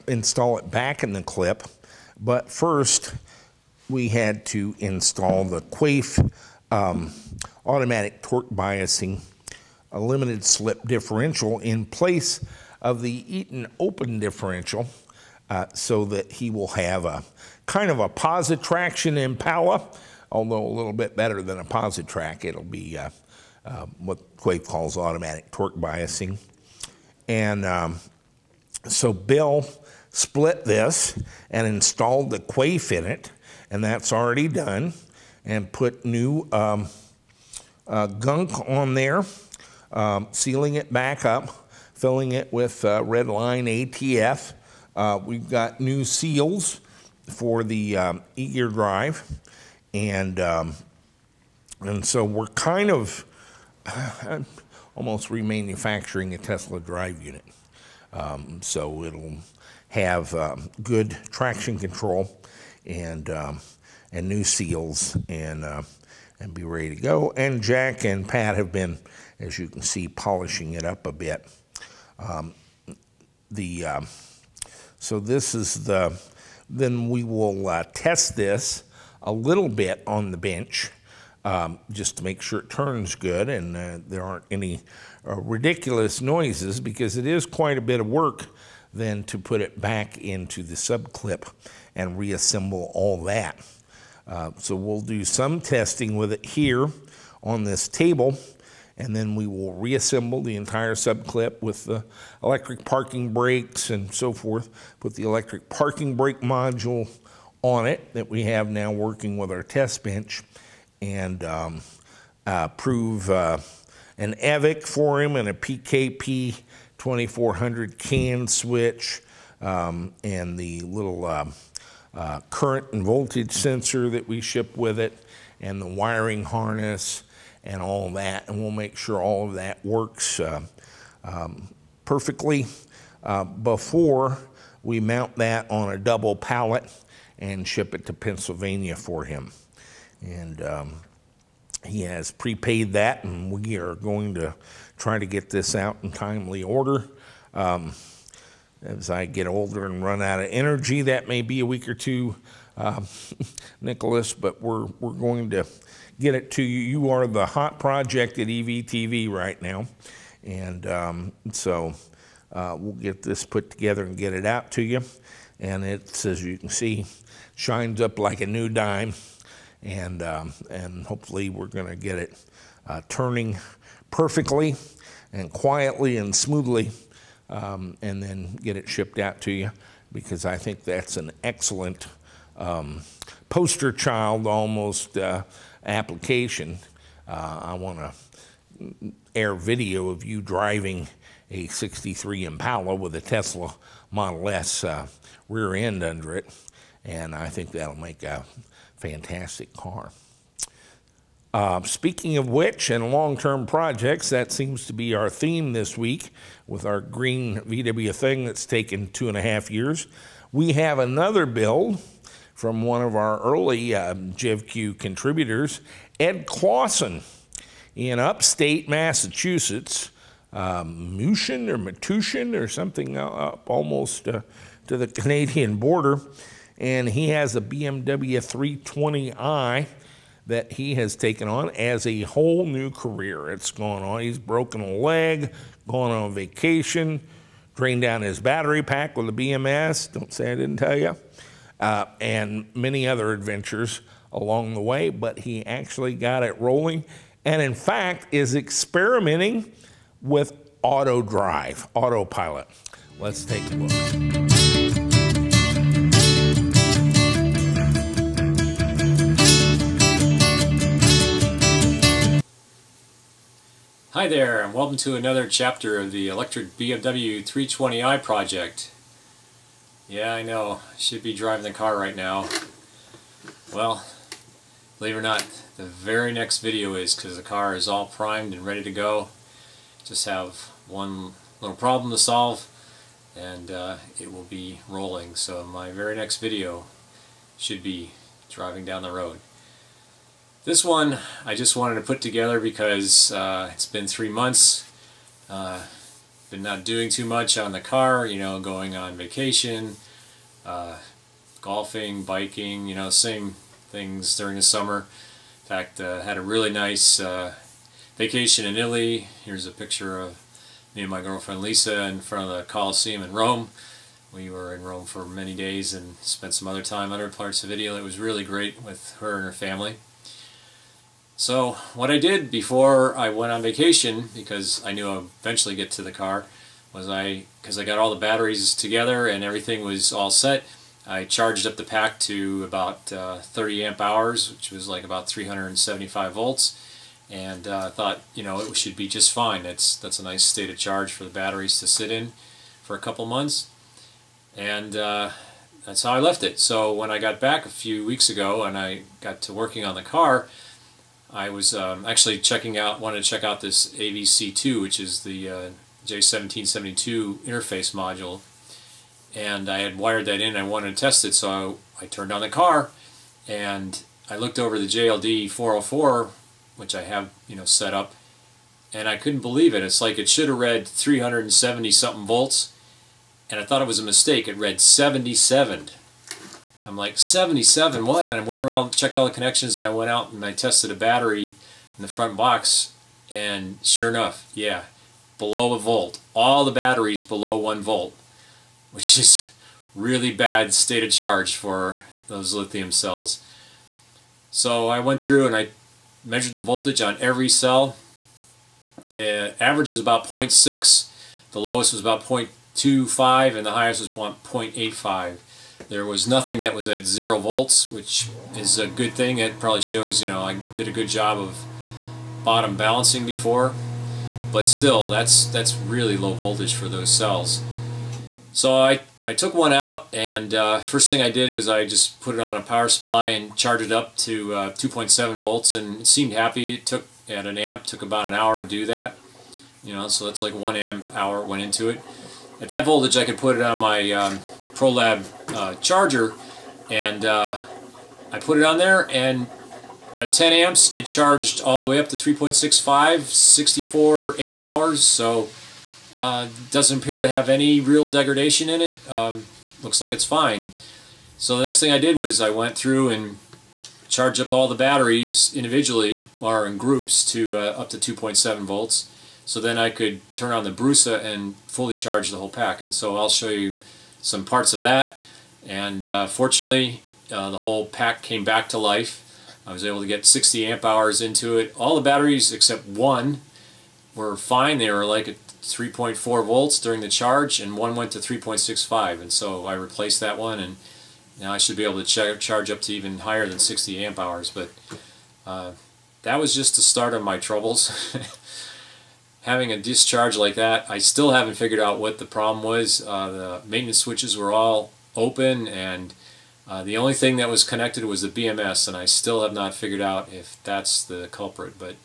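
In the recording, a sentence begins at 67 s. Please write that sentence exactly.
And Jack and Pat have been, as you can see, polishing it up a bit.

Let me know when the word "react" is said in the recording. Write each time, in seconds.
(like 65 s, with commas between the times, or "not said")
not said.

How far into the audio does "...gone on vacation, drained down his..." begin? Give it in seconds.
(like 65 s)
235 s.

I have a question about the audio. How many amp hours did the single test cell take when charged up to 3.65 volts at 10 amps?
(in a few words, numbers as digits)
64.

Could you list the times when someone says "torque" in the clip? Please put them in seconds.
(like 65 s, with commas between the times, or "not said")
8 s, 25 s.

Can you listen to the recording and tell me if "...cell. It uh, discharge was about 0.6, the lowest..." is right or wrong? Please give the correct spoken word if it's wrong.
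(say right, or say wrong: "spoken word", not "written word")
wrong: "average", not "discharge".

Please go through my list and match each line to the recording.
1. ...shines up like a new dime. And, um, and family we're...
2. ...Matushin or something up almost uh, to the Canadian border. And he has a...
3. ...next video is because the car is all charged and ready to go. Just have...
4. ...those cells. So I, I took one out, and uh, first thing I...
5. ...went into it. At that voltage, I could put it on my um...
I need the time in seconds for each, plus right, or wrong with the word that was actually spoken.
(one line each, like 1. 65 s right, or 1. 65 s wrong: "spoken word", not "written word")
1. 167 s wrong: "hopefully", not "family"
2. 221 s right
3. 276 s wrong: "primed", not "charged"
4. 416 s right
5. 431 s right.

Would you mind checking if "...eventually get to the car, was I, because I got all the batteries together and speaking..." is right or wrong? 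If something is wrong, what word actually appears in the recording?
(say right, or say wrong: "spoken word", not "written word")
wrong: "everything", not "speaking".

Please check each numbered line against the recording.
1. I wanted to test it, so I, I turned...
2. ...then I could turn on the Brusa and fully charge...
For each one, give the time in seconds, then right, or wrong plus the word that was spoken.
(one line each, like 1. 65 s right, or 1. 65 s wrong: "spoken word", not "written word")
1. 360 s right
2. 459 s right.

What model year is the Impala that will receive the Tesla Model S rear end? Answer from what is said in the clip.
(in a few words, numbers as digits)
63.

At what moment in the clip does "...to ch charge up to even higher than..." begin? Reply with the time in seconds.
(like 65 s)
482 s.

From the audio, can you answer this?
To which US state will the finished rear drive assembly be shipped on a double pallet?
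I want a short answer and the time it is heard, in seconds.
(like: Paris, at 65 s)
Pennsylvania, at 138 s.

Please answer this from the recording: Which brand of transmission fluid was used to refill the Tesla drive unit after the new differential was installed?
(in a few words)
Redline ATF.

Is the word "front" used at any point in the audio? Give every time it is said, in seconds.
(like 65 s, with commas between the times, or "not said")
312 s, 382 s.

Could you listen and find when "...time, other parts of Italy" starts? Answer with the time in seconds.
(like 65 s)
316 s.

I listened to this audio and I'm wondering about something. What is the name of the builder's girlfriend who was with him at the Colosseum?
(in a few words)
Lisa.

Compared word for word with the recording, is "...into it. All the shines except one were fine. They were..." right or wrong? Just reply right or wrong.
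wrong.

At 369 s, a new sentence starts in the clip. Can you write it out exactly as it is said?
It's like it should have read 370 something volts, and I thought it was a mistake.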